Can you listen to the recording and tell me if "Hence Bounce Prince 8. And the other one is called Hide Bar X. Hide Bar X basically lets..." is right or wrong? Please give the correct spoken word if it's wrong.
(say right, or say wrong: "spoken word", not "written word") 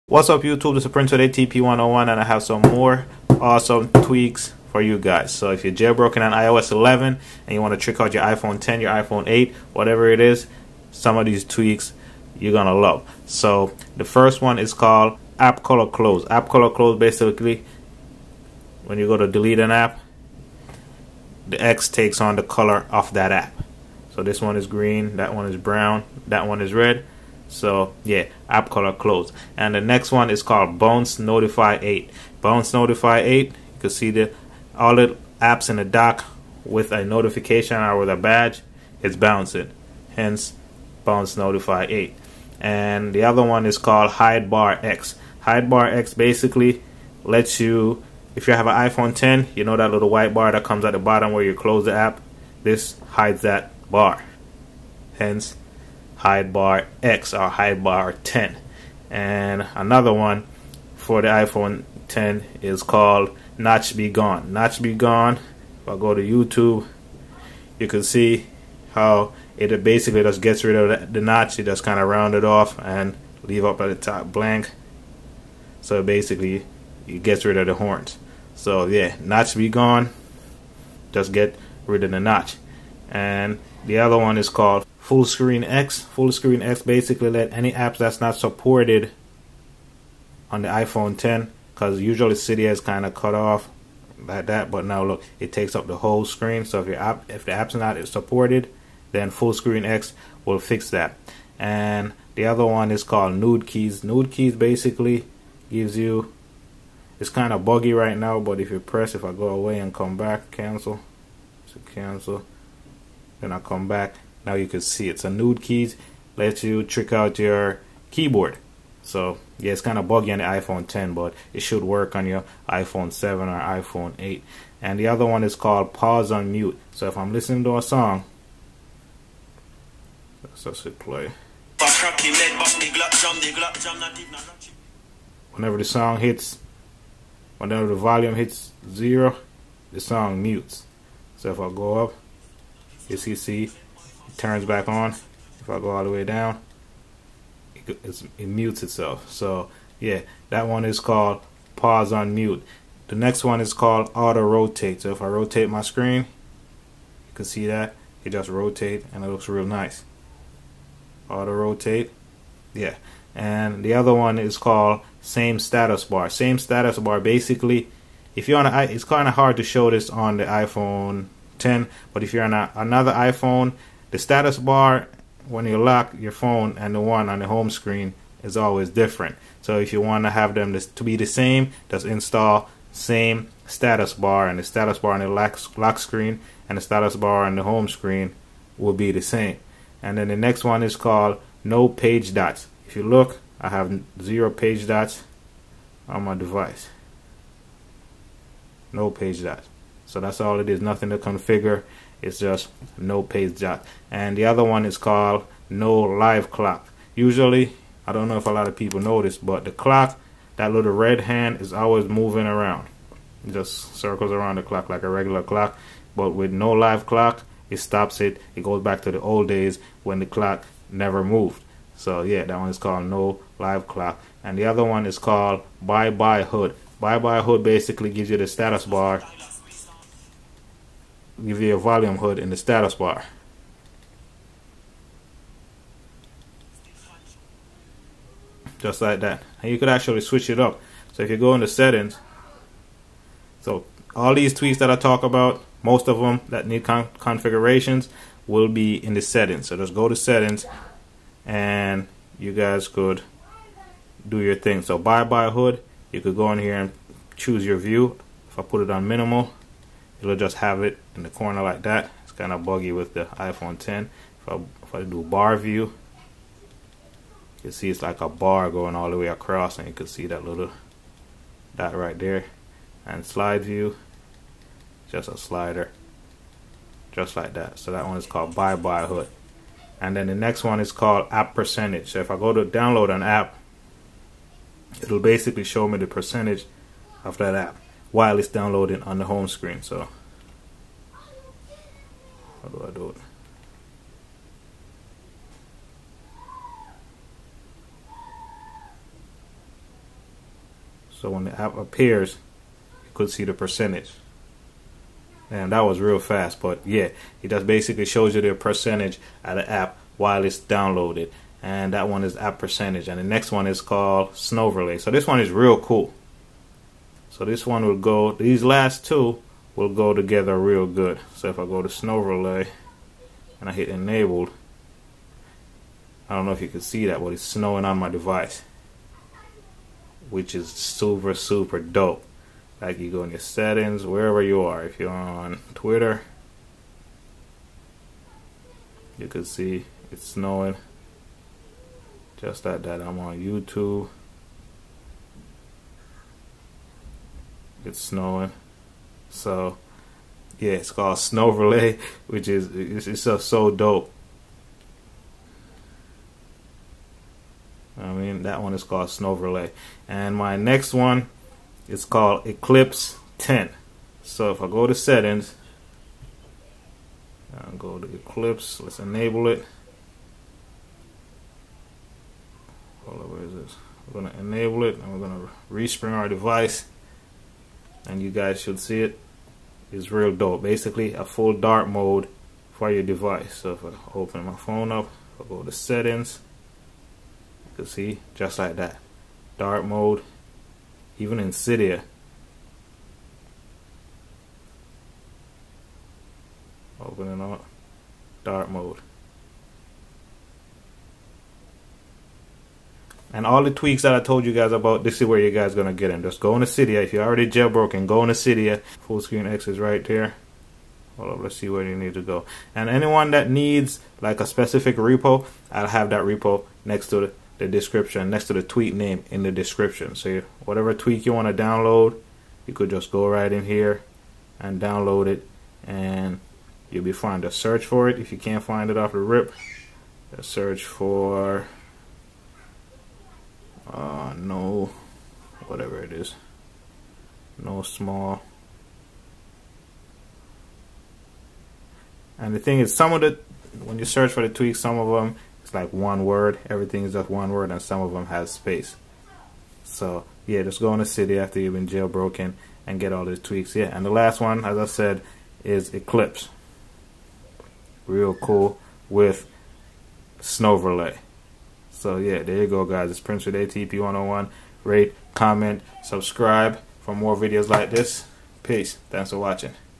wrong: "Notify", not "Prince".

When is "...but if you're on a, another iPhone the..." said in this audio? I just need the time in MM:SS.
02:52.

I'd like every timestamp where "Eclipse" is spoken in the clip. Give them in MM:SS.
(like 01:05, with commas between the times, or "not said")
06:02, 06:08, 07:35.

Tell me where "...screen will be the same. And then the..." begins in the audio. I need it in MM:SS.
03:07.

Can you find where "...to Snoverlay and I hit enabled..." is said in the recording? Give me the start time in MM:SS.
05:21.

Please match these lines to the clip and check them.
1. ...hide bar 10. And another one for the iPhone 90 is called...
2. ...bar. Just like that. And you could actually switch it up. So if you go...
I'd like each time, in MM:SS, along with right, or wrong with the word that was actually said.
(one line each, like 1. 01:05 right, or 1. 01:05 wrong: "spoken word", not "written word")
1. 00:57 wrong: "10", not "90"
2. 03:52 right.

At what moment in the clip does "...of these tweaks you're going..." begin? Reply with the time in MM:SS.
00:11.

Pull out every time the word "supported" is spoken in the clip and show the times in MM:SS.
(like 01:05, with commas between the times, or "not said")
01:28, 01:38.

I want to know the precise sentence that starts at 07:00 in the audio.
So you, whatever tweak you want to download, you could just go right in here and download it, and you'll be fine.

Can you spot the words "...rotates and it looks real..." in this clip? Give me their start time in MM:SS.
02:38.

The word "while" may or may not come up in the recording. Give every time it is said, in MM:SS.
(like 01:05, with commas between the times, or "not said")
04:48, 05:10.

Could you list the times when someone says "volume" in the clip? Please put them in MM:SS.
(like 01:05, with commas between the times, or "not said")
02:17, 03:51.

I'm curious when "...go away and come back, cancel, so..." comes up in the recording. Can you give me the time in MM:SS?
01:49.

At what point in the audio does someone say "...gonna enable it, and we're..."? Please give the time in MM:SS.
06:14.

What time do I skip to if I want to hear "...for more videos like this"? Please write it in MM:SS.
07:47.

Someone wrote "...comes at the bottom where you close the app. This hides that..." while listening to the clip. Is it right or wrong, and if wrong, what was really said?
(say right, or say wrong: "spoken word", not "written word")
right.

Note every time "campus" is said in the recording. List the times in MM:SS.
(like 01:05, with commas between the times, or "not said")
not said.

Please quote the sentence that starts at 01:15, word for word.
So basically, it gets rid of the horns.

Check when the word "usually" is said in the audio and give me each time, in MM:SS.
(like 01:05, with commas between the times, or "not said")
01:31, 03:27.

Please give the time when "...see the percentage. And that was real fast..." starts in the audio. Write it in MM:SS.
05:03.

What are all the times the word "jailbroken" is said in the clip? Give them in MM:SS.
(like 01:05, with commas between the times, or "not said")
00:05, 06:47, 07:31.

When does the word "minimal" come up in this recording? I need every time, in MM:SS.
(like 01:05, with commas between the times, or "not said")
04:19.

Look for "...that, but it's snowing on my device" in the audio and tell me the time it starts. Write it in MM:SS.
05:27.